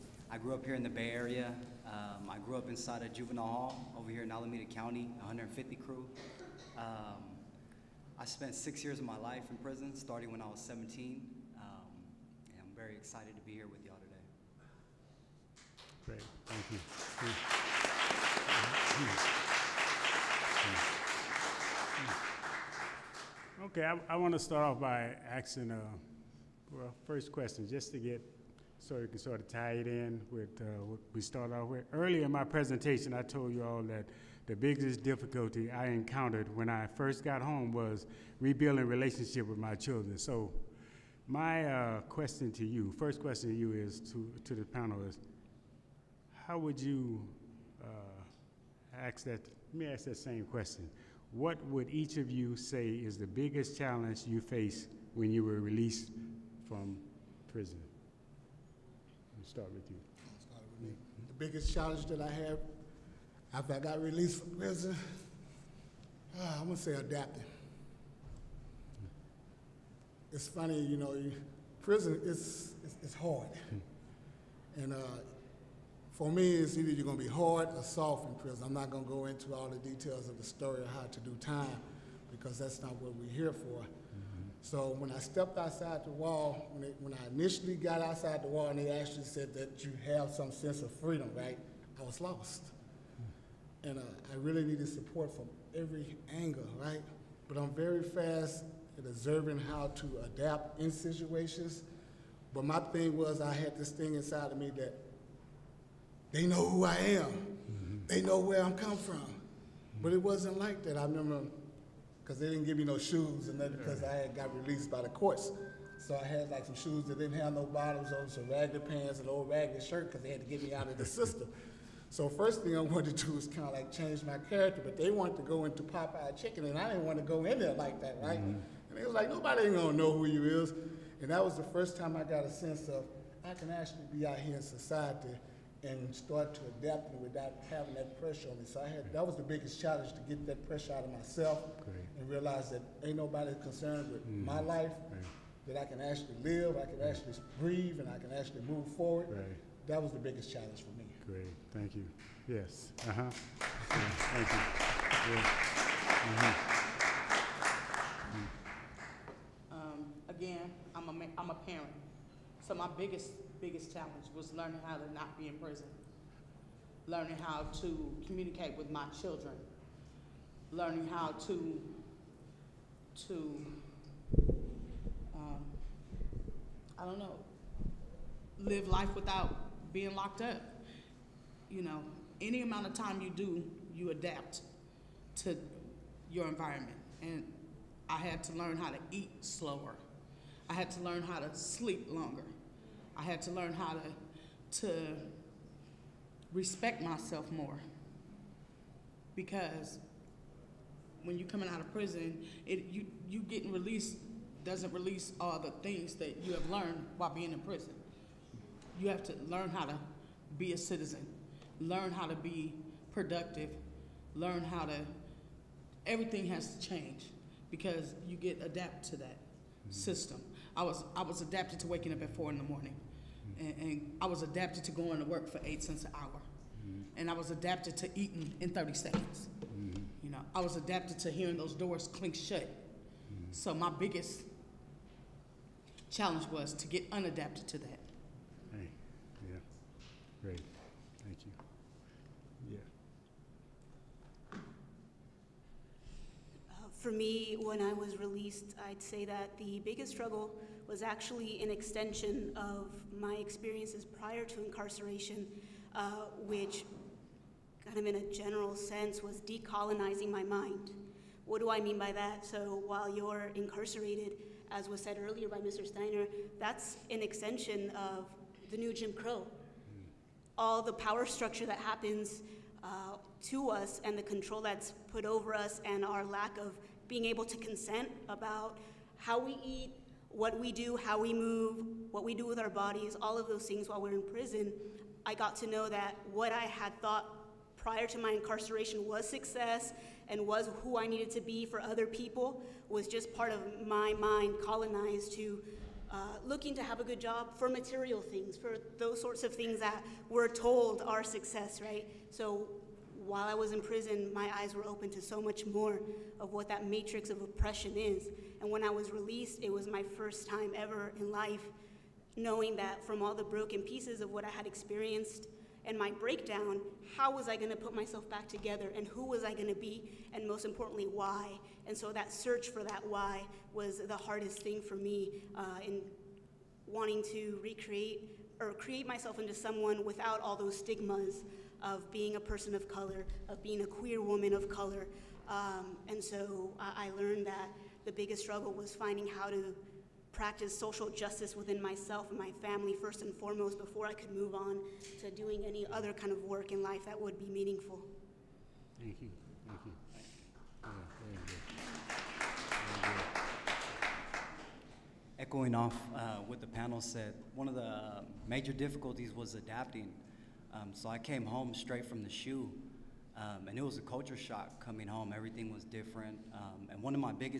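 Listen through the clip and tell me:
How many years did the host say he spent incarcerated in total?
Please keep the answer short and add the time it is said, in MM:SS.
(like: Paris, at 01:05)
6, at 00:08.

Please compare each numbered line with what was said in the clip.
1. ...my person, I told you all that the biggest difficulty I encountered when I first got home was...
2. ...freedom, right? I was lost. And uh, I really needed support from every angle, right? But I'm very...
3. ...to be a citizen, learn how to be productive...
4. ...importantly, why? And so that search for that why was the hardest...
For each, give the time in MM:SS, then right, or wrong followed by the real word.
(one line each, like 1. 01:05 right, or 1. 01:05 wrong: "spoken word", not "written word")
1. 00:32 wrong: "presentation", not "person"
2. 01:30 right
3. 03:29 right
4. 05:20 right.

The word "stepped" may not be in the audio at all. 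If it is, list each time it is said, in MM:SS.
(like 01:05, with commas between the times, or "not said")
01:25.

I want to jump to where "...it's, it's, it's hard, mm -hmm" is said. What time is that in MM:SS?
01:12.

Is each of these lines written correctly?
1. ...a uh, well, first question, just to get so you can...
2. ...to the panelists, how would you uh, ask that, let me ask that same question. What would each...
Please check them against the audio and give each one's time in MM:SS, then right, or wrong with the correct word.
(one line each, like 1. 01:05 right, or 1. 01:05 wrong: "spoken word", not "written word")
1. 00:25 right
2. 00:44 right.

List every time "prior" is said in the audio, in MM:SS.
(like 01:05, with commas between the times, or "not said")
04:14, 04:47.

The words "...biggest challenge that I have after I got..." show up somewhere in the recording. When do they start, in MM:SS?
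01:01.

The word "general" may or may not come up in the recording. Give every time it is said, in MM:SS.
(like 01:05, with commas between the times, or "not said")
04:18.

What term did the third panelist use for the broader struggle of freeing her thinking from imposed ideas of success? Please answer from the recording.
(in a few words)
decolonizing my mind.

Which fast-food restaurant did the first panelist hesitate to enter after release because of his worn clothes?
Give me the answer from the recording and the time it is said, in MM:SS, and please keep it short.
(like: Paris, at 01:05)
Popeye Chicken, at 02:05.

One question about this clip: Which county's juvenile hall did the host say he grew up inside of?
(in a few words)
Alameda County.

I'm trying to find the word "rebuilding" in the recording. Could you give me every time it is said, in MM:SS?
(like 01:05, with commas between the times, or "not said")
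00:38.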